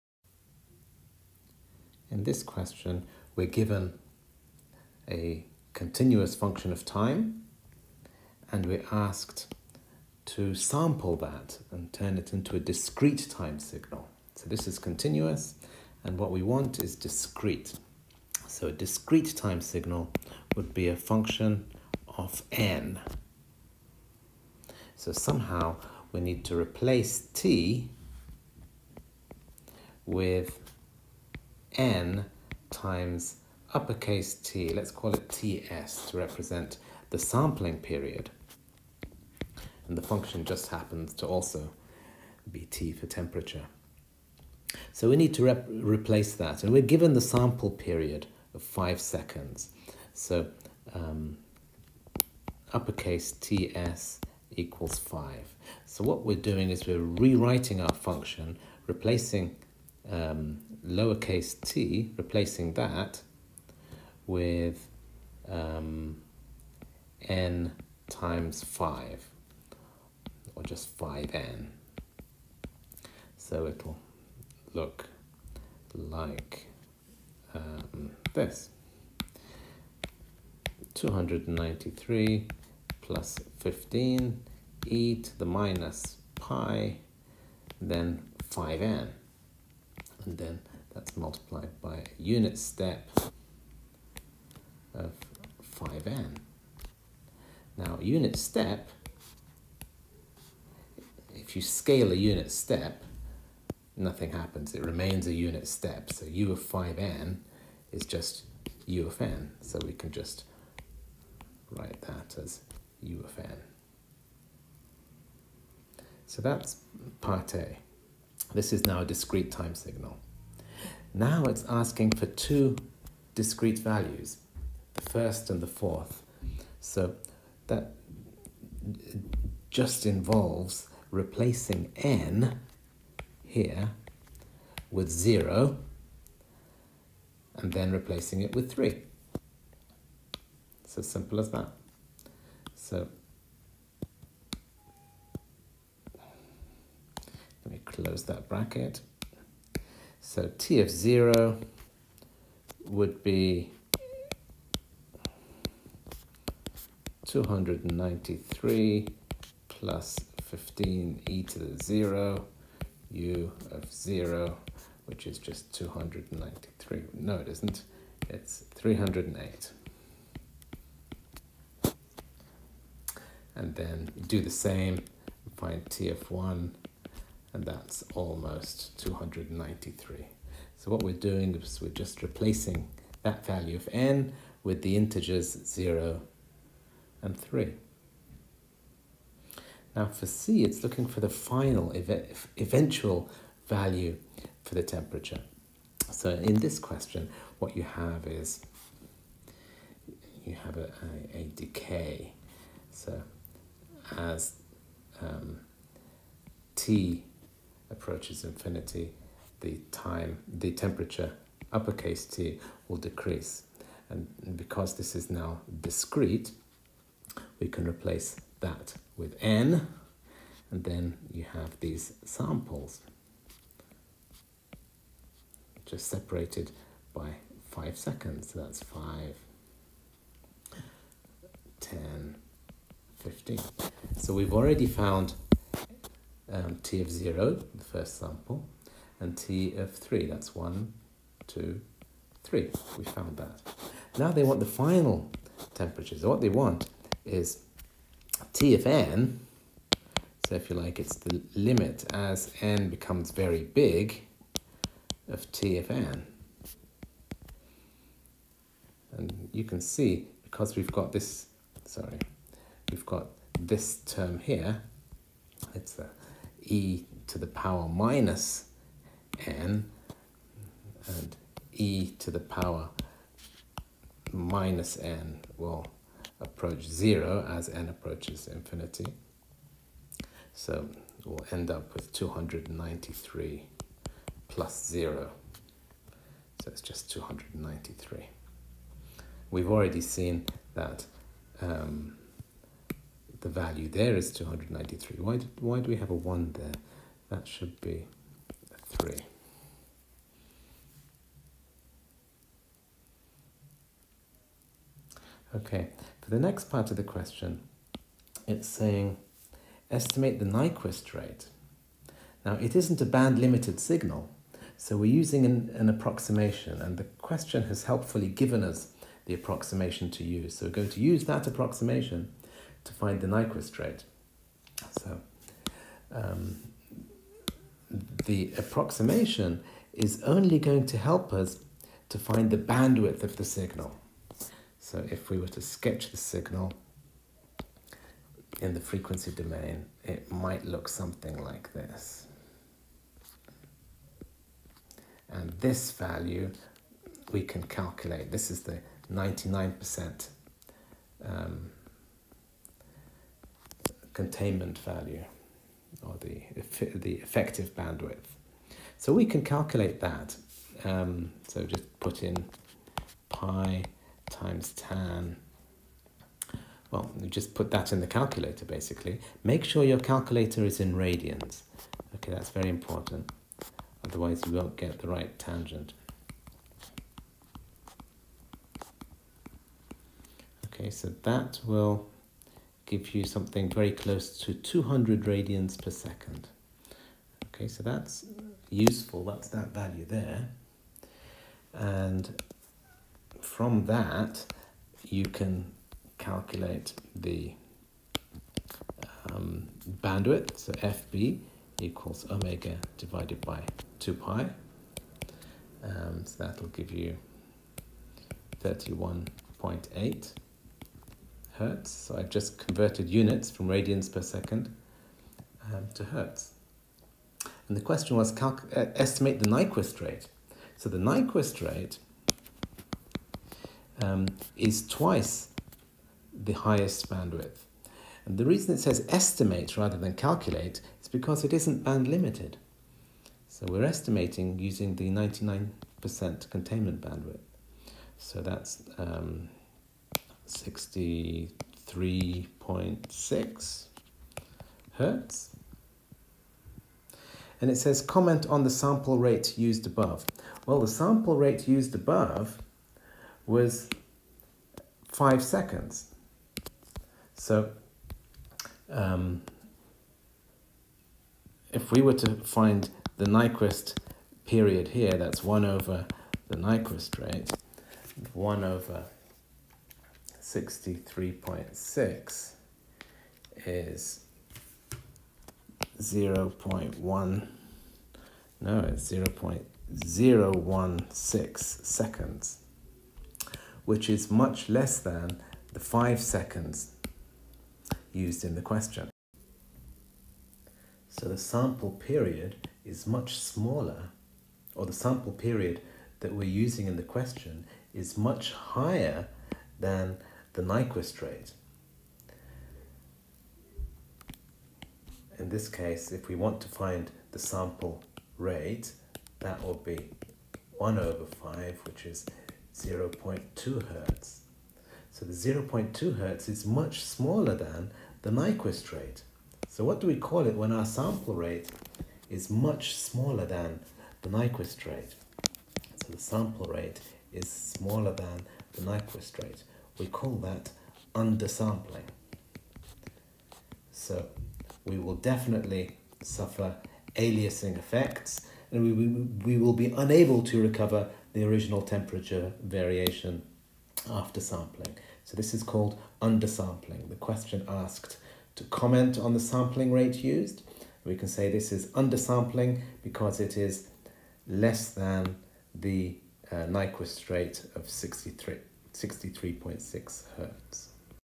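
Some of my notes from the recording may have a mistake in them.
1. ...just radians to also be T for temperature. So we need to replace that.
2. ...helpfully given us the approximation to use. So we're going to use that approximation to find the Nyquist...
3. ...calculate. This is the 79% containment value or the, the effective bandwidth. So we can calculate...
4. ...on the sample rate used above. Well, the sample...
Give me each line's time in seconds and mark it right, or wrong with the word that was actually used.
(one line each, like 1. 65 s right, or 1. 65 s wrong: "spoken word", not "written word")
1. 40 s wrong: "happens", not "radians"
2. 317 s right
3. 347 s wrong: "99", not "79"
4. 448 s right.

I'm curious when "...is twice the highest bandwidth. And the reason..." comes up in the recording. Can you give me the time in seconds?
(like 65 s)
424 s.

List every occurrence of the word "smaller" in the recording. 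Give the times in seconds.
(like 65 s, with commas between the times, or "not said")
493 s, 517 s, 522 s, 527 s.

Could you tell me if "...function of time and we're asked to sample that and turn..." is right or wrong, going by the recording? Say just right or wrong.
right.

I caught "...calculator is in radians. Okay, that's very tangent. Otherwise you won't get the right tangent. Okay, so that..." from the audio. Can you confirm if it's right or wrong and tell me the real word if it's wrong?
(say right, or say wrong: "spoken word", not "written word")
wrong: "important", not "tangent".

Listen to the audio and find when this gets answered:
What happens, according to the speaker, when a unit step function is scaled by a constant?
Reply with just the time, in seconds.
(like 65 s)
103 s.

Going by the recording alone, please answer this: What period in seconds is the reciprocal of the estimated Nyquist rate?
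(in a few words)
0.016 seconds.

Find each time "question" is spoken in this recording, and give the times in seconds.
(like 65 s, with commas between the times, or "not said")
2 s, 196 s, 307 s, 317 s, 417 s, 488 s, 497 s, 547 s.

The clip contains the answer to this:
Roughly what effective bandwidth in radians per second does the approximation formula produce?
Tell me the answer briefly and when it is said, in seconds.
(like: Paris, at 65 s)
200 radians per second, at 384 s.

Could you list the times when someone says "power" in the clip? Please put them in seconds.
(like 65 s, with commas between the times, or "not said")
267 s, 272 s.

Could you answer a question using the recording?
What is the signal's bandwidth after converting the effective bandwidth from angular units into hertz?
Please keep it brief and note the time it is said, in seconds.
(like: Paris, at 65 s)
31.8 hertz, at 408 s.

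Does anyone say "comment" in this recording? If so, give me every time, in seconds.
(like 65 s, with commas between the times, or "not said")
448 s, 548 s.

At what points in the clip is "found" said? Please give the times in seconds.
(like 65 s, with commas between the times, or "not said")
234 s, 243 s.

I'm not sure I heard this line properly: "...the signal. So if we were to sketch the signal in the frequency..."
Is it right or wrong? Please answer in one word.
right.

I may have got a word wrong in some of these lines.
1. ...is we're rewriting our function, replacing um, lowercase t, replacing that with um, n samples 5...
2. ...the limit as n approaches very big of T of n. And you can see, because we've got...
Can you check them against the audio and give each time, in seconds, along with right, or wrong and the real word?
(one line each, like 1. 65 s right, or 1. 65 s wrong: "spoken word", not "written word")
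1. 56 s wrong: "times", not "samples"
2. 251 s wrong: "becomes", not "approaches".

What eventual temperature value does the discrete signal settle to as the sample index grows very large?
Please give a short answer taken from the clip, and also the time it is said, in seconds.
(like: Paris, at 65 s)
293, at 286 s.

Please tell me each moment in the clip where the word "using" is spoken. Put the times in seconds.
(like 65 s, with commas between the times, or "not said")
315 s, 434 s, 496 s.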